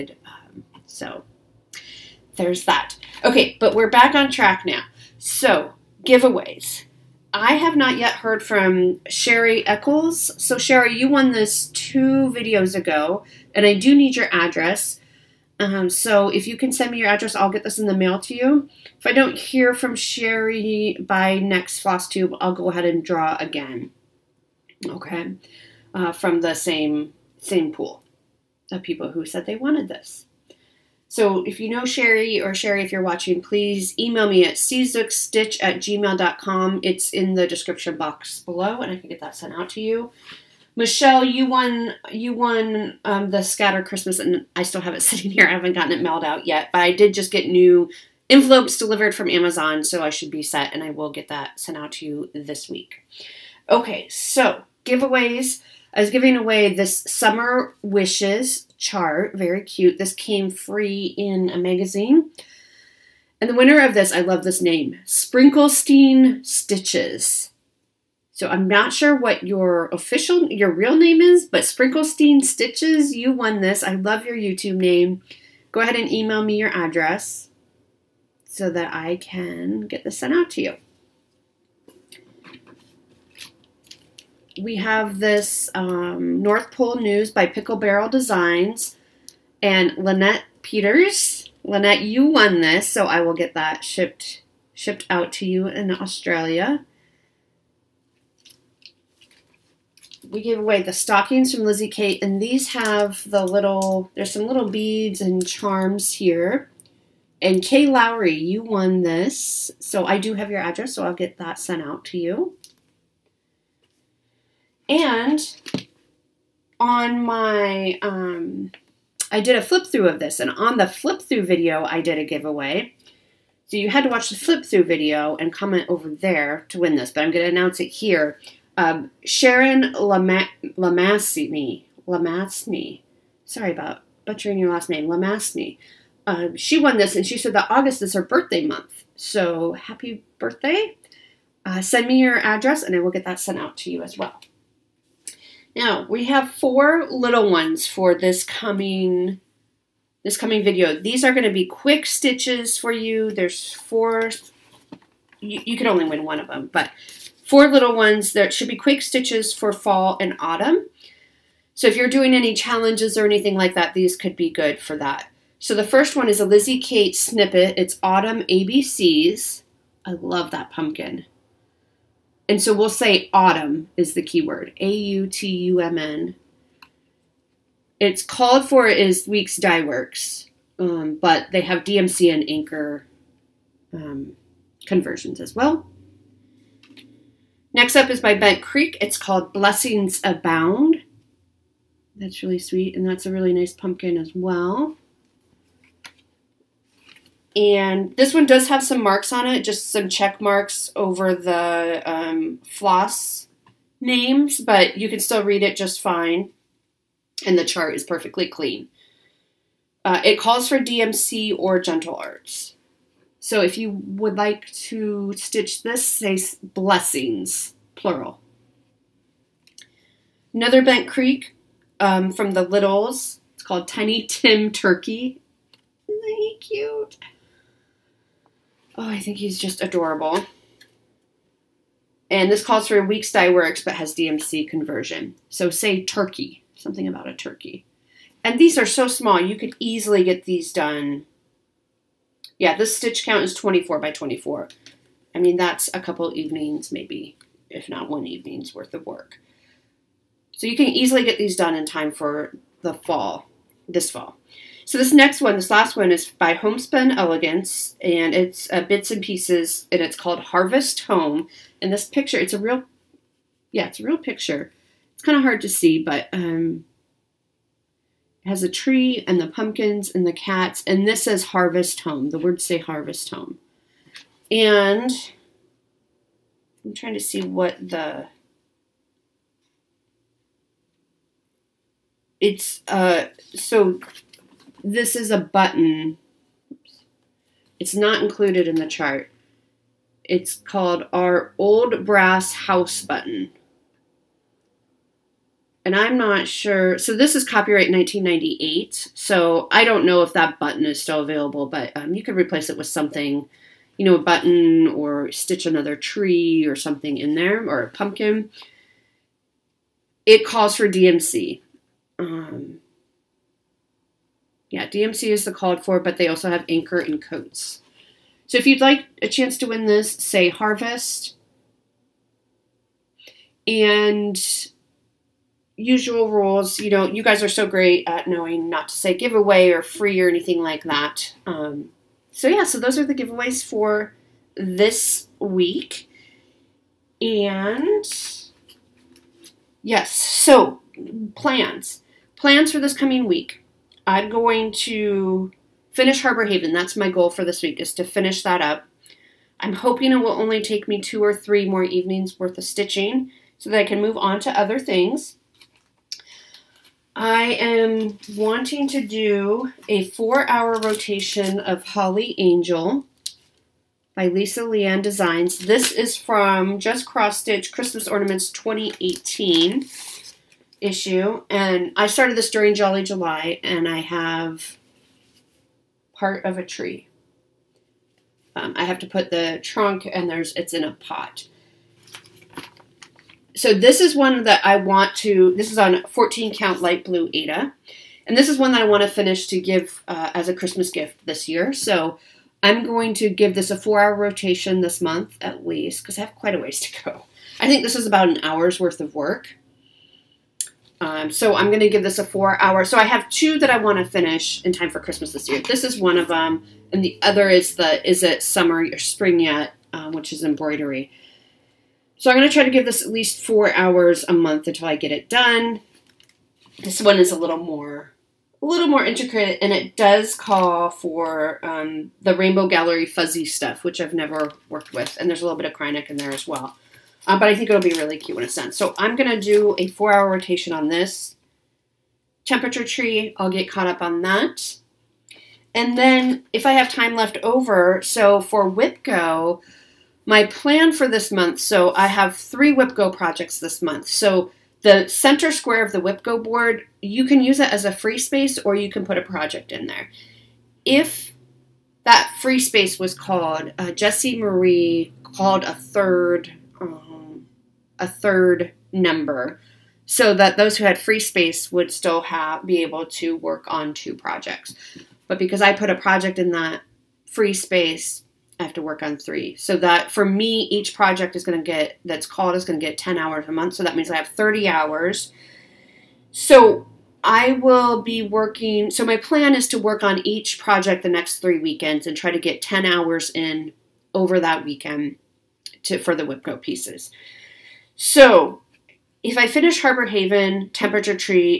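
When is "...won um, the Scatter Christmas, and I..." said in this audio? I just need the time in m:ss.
0:42.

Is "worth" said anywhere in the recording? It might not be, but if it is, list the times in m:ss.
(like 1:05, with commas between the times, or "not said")
4:08, 5:52, 6:38.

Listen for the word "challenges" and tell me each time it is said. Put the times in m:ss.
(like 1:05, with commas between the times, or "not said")
2:42.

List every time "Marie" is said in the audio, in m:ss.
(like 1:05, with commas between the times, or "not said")
7:34.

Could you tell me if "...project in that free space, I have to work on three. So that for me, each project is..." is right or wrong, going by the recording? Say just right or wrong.
right.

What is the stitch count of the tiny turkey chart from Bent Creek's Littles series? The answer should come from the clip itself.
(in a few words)
24 by 24.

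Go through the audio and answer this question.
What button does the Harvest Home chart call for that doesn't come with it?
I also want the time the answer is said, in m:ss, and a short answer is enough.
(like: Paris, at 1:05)
old brass house button, at 4:51.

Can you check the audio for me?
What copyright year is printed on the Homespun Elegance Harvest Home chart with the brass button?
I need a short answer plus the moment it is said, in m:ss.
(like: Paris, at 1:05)
1998, at 4:57.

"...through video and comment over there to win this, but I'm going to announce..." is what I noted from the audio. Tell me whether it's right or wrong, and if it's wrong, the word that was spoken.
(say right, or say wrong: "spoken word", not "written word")
right.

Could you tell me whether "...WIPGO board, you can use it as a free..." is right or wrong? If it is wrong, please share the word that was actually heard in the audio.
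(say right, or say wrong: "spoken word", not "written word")
right.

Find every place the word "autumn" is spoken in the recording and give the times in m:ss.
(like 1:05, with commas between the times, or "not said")
2:40, 2:48, 2:53.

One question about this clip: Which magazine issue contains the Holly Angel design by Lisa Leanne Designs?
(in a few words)
Just Cross Stitch Christmas Ornaments 2018.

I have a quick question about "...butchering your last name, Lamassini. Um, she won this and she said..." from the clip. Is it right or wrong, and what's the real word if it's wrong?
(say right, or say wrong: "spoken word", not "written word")
right.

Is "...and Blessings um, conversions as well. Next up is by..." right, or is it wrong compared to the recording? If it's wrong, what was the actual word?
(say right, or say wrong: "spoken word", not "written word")
wrong: "Anchor", not "Blessings".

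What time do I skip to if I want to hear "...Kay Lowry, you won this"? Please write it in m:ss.
1:47.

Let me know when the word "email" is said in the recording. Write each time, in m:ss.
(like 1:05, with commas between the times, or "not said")
0:33, 1:16.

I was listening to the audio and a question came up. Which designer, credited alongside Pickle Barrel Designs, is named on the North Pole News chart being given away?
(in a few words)
Lynette Peters.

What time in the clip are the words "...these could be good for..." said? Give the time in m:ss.
2:43.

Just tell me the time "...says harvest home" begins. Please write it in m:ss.
4:31.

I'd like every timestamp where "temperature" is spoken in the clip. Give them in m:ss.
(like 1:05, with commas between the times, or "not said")
7:12, 8:10.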